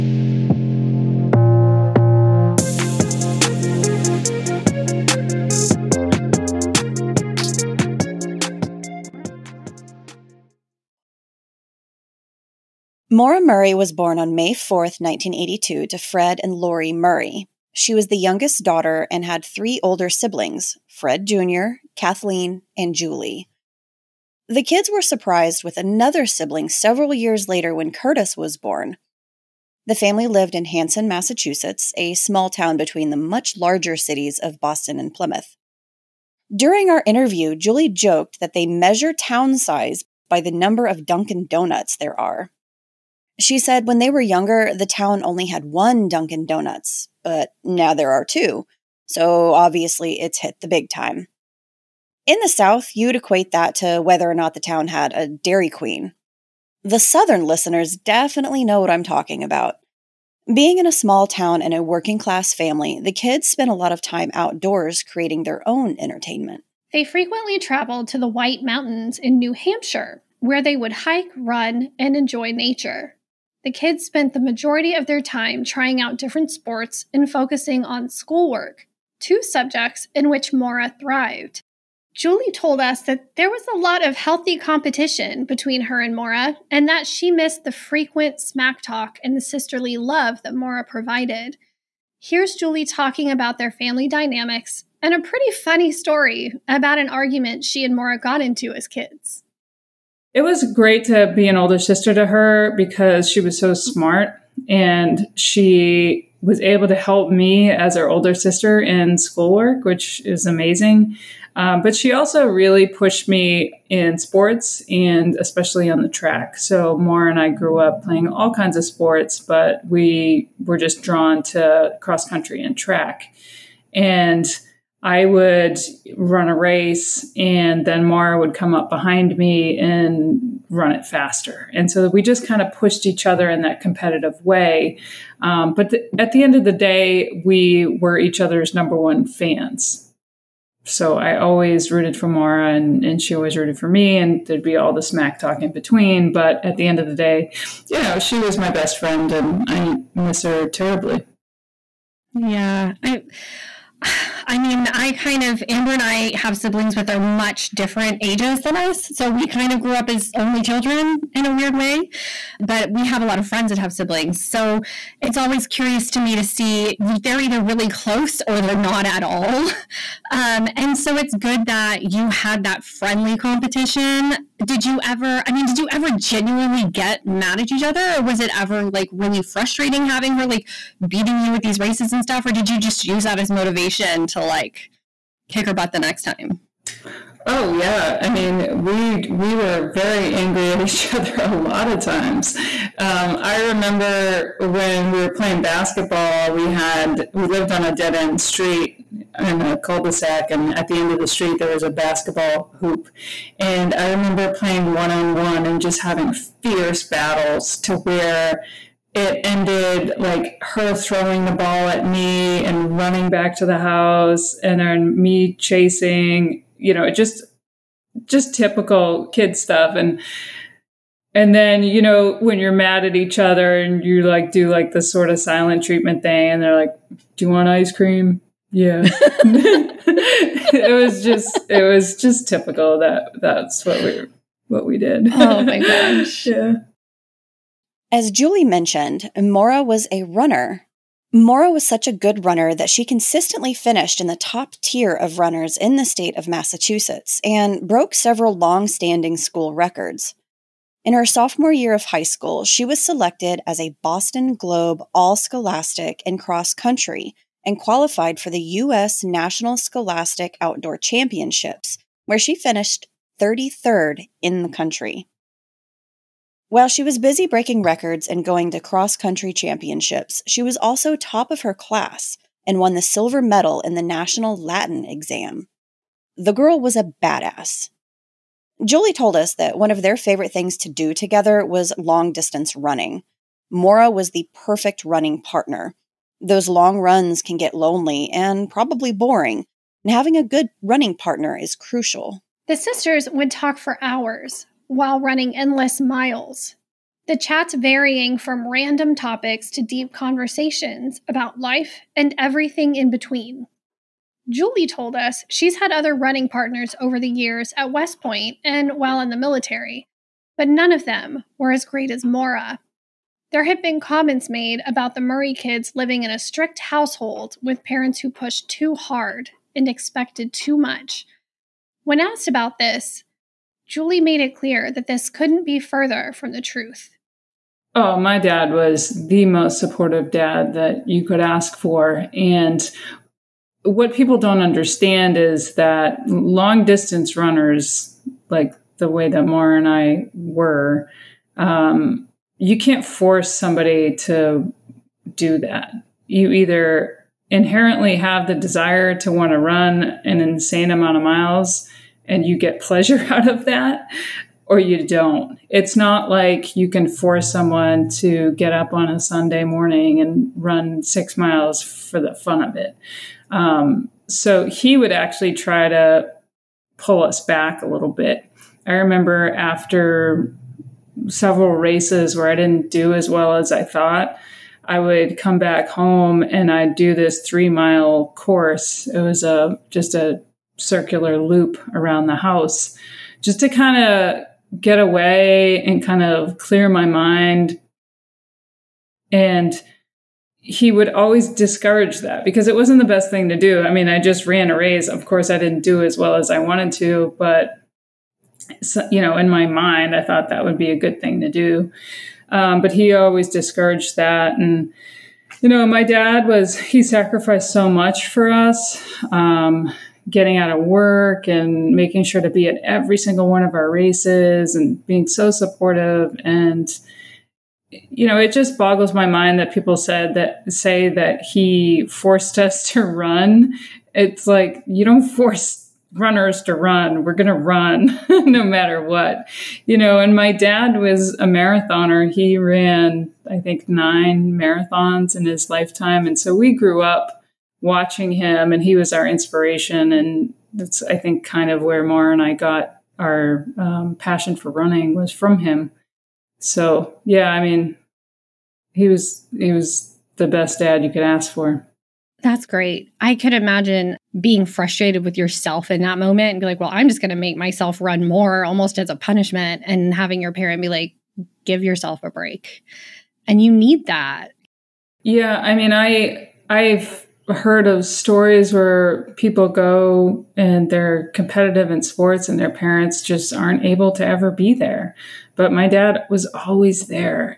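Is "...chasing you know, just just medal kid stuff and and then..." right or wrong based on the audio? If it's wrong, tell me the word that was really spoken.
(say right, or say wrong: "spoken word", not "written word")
wrong: "typical", not "medal".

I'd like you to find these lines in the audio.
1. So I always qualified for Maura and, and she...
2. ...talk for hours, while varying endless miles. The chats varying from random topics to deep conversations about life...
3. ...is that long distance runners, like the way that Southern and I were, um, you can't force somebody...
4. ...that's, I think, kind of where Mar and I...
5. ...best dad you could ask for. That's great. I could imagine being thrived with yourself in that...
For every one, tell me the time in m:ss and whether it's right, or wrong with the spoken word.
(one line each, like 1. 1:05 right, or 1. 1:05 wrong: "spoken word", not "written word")
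1. 2:20 wrong: "rooted", not "qualified"
2. 4:53 wrong: "running", not "varying"
3. 5:35 wrong: "Maura", not "Southern"
4. 7:20 right
5. 7:30 wrong: "frustrated", not "thrived".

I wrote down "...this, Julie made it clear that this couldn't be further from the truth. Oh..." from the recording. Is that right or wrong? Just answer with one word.
right.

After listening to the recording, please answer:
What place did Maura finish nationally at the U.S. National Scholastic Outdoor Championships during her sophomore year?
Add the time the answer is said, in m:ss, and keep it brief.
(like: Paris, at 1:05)
33rd, at 4:23.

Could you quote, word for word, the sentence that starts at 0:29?
The family lived in Hanson, Massachusetts, a small town between the much larger cities of Boston and Plymouth.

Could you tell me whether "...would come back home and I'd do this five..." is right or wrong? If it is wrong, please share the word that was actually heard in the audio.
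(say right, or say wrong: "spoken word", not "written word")
wrong: "three", not "five".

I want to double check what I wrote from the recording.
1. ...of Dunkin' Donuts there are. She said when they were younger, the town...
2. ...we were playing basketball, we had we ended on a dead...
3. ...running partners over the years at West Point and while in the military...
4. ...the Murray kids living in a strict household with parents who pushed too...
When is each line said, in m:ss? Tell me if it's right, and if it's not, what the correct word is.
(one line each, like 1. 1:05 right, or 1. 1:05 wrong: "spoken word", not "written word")
1. 0:40 right
2. 3:15 wrong: "lived", not "ended"
3. 5:06 right
4. 5:15 right.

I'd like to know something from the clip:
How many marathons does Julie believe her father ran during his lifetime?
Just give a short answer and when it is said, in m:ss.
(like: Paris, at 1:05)
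9, at 7:13.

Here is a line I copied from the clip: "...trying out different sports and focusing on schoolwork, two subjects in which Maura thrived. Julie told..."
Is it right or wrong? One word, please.
right.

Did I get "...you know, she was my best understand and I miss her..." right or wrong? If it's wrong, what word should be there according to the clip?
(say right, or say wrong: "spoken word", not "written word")
wrong: "friend", not "understand".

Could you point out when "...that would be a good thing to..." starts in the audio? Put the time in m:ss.
6:40.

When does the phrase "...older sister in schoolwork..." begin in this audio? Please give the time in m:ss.
1:48.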